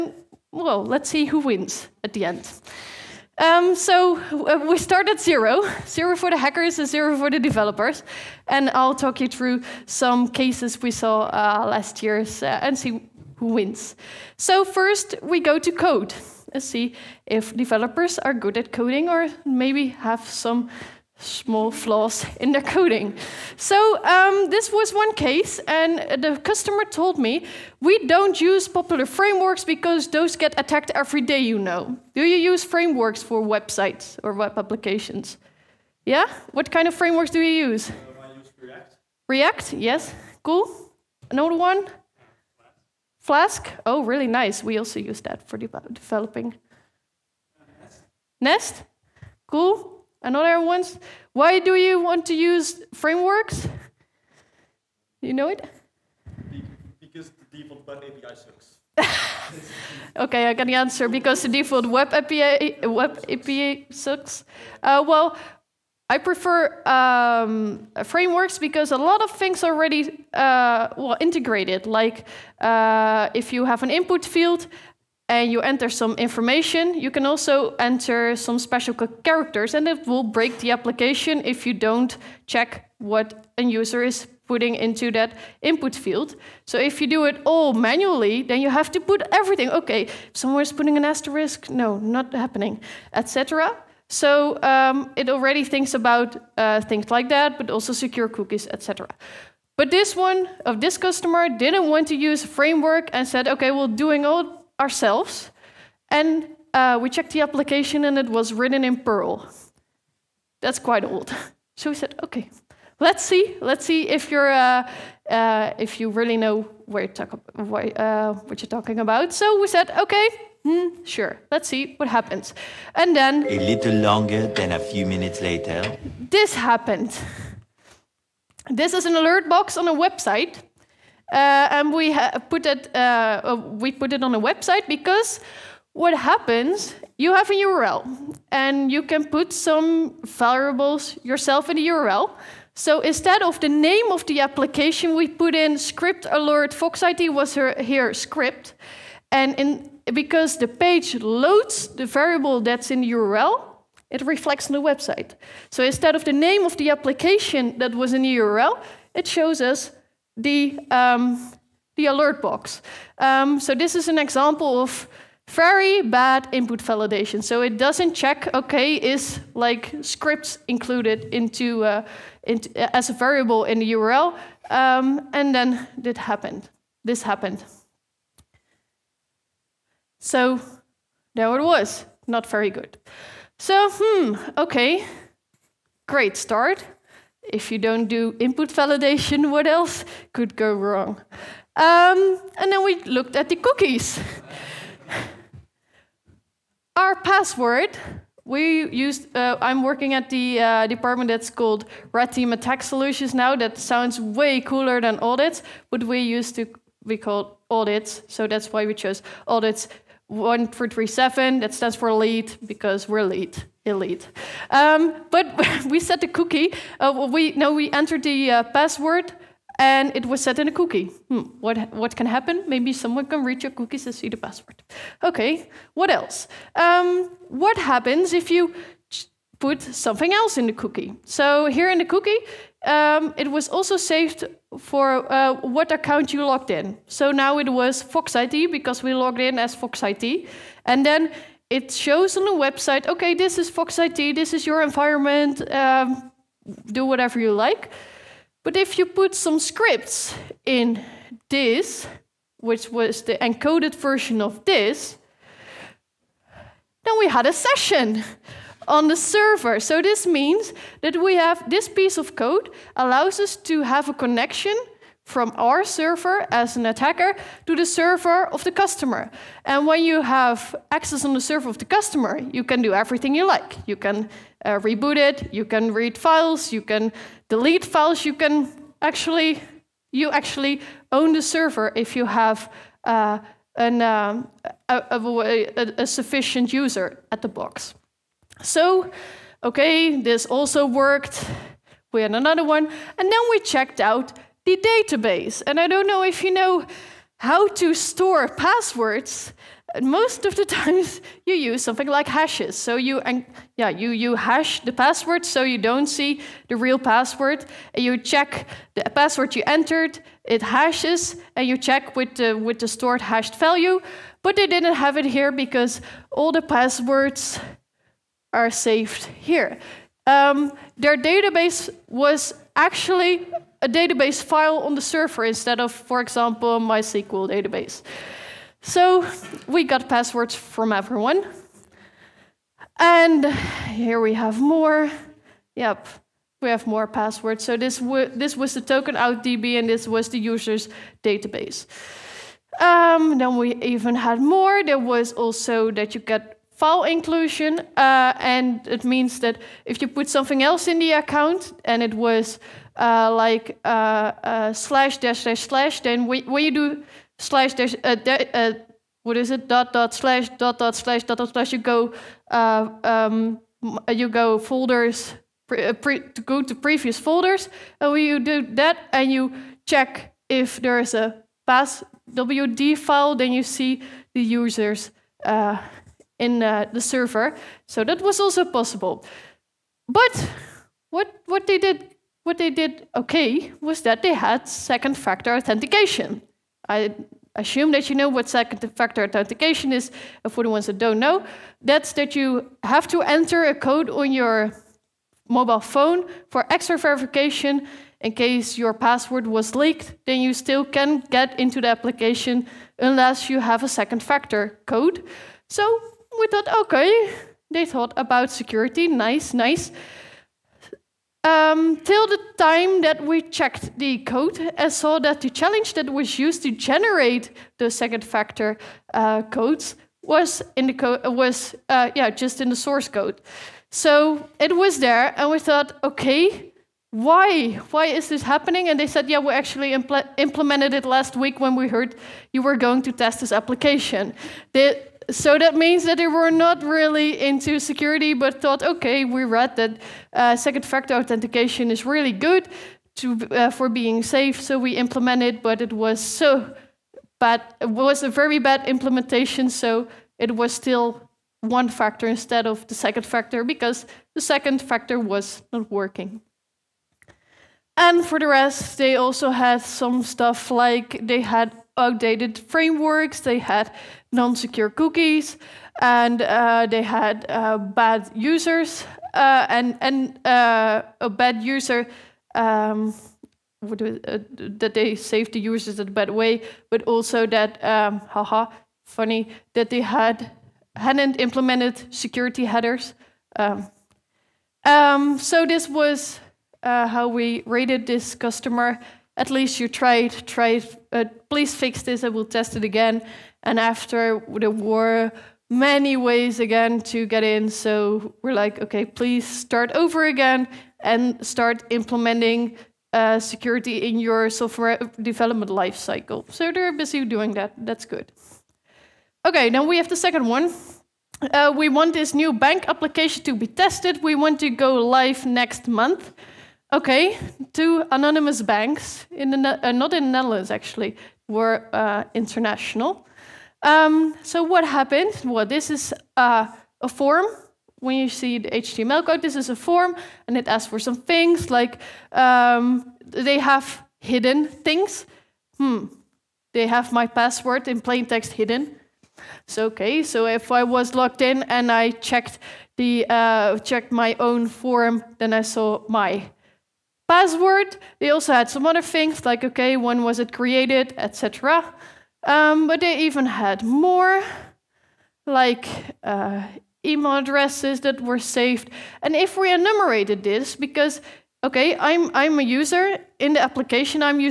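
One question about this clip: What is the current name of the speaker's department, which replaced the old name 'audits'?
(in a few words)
Red Team Attack Solutions.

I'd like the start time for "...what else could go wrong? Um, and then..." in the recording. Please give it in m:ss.
3:09.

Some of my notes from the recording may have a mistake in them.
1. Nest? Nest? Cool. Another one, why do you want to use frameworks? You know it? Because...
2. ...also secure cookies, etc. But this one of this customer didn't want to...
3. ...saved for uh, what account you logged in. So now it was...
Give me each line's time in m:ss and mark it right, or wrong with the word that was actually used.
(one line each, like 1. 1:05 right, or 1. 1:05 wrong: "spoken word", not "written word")
1. 0:47 right
2. 1:37 right
3. 3:53 right.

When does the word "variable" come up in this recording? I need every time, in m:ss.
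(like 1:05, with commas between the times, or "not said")
2:20, 2:32, 2:53.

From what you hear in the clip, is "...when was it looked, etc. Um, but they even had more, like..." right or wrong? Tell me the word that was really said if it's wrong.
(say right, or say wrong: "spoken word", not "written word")
wrong: "created", not "looked".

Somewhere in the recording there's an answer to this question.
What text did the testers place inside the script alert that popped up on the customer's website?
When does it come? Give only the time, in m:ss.
2:26.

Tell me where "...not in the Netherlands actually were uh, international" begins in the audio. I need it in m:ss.
8:39.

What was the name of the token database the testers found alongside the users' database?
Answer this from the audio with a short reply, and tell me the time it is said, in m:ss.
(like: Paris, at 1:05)
token out DB, at 5:38.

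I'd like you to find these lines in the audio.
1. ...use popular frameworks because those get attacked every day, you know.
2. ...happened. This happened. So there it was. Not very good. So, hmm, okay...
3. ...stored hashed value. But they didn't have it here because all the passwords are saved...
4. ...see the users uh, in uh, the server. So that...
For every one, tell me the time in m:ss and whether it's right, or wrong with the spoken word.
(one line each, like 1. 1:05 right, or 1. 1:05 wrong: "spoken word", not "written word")
1. 0:28 right
2. 2:56 right
3. 5:12 right
4. 6:13 right.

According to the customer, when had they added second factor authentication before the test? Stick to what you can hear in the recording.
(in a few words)
last week.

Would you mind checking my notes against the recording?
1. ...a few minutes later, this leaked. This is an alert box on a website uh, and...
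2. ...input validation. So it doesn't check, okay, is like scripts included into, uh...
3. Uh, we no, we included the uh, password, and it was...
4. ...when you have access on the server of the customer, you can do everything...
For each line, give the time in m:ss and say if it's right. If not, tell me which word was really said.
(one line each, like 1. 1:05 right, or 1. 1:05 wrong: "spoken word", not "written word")
1. 2:04 wrong: "happened", not "leaked"
2. 2:46 right
3. 3:36 wrong: "entered", not "included"
4. 4:29 right.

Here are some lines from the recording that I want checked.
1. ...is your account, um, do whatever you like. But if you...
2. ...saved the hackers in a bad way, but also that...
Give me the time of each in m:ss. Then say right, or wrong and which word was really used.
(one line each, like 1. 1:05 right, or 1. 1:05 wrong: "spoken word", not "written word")
1. 4:04 wrong: "environment", not "account"
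2. 7:55 wrong: "users", not "hackers".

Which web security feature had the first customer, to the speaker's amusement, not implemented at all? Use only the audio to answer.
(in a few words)
security headers.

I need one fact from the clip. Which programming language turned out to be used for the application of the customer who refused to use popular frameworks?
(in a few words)
Perl.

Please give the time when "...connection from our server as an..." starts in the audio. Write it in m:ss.
4:24.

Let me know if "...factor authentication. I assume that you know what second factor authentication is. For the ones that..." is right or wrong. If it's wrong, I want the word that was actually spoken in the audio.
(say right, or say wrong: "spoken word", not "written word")
right.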